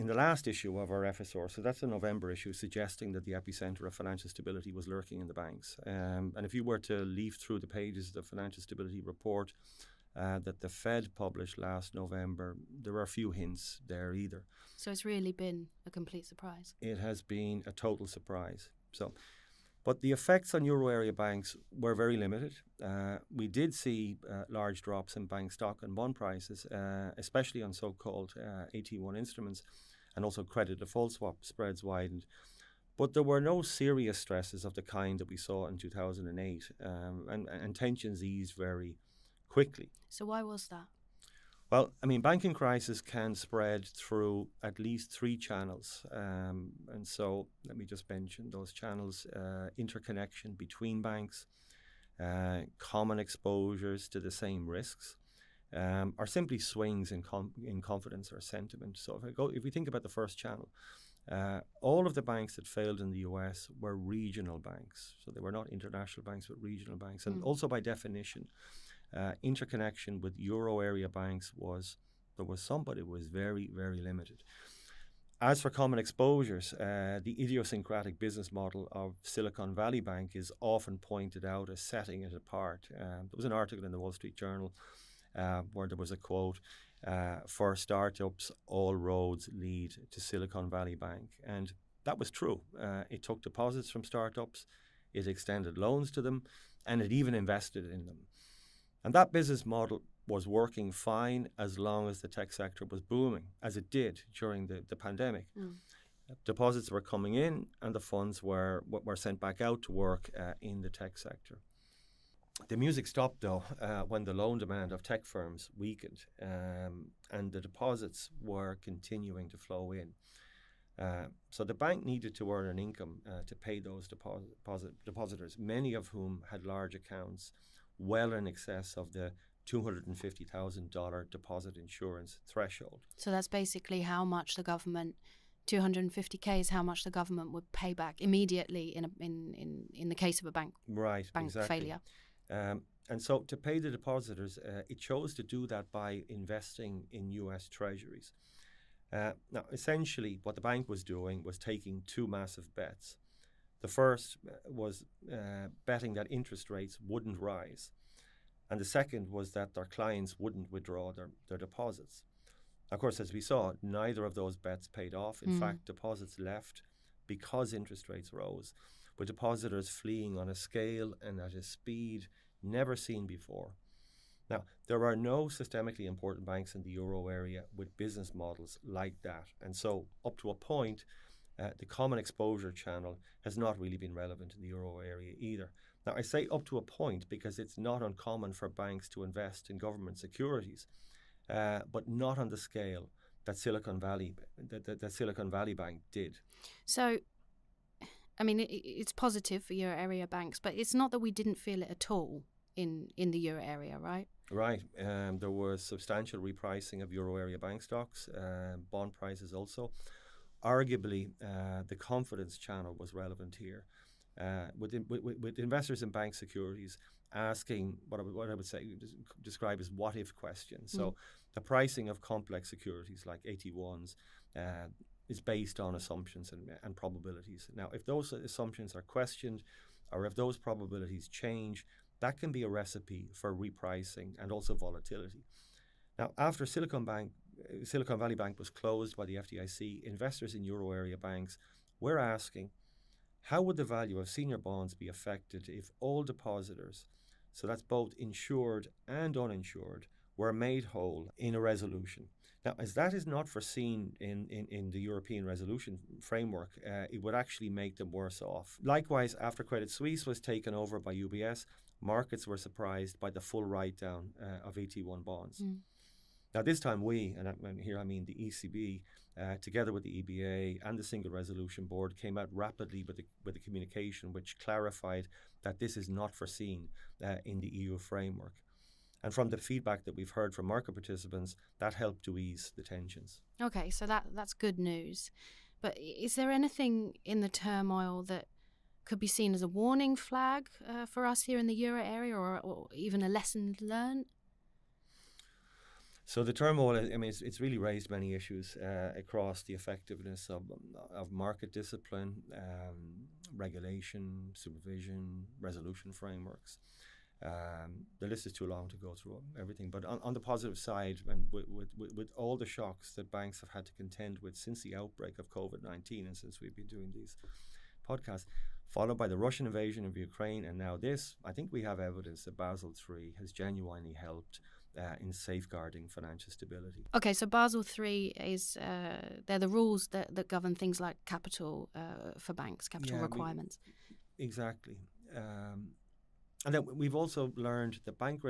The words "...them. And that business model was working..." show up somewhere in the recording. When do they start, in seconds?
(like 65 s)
98 s.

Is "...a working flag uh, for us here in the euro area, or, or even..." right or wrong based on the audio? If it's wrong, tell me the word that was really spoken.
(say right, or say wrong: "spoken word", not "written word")
wrong: "warning", not "working".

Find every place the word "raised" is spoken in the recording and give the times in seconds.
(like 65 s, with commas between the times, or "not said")
297 s.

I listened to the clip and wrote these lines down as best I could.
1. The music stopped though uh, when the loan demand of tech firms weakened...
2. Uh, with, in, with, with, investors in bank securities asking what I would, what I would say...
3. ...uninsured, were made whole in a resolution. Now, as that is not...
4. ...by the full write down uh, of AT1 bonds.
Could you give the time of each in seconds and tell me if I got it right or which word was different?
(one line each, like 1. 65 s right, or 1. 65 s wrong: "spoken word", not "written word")
1. 112 s right
2. 214 s right
3. 249 s right
4. 263 s right.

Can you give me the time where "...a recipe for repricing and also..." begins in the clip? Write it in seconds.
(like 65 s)
232 s.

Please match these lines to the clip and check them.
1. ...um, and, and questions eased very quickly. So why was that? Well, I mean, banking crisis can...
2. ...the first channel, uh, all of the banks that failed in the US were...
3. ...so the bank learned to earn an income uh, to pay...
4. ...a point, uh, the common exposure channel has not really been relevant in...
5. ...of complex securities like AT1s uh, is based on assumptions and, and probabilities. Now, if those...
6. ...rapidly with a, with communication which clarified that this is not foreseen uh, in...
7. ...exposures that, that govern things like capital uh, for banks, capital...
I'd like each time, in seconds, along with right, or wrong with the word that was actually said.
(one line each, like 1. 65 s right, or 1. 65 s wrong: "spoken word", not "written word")
1. 36 s wrong: "tensions", not "questions"
2. 60 s right
3. 121 s wrong: "needed", not "learned"
4. 180 s right
5. 222 s right
6. 272 s right
7. 329 s wrong: "rules", not "exposures".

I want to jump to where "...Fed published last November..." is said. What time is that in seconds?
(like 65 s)
10 s.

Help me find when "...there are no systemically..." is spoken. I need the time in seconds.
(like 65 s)
174 s.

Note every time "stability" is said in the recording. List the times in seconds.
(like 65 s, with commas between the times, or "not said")
4 s, 8 s, 326 s.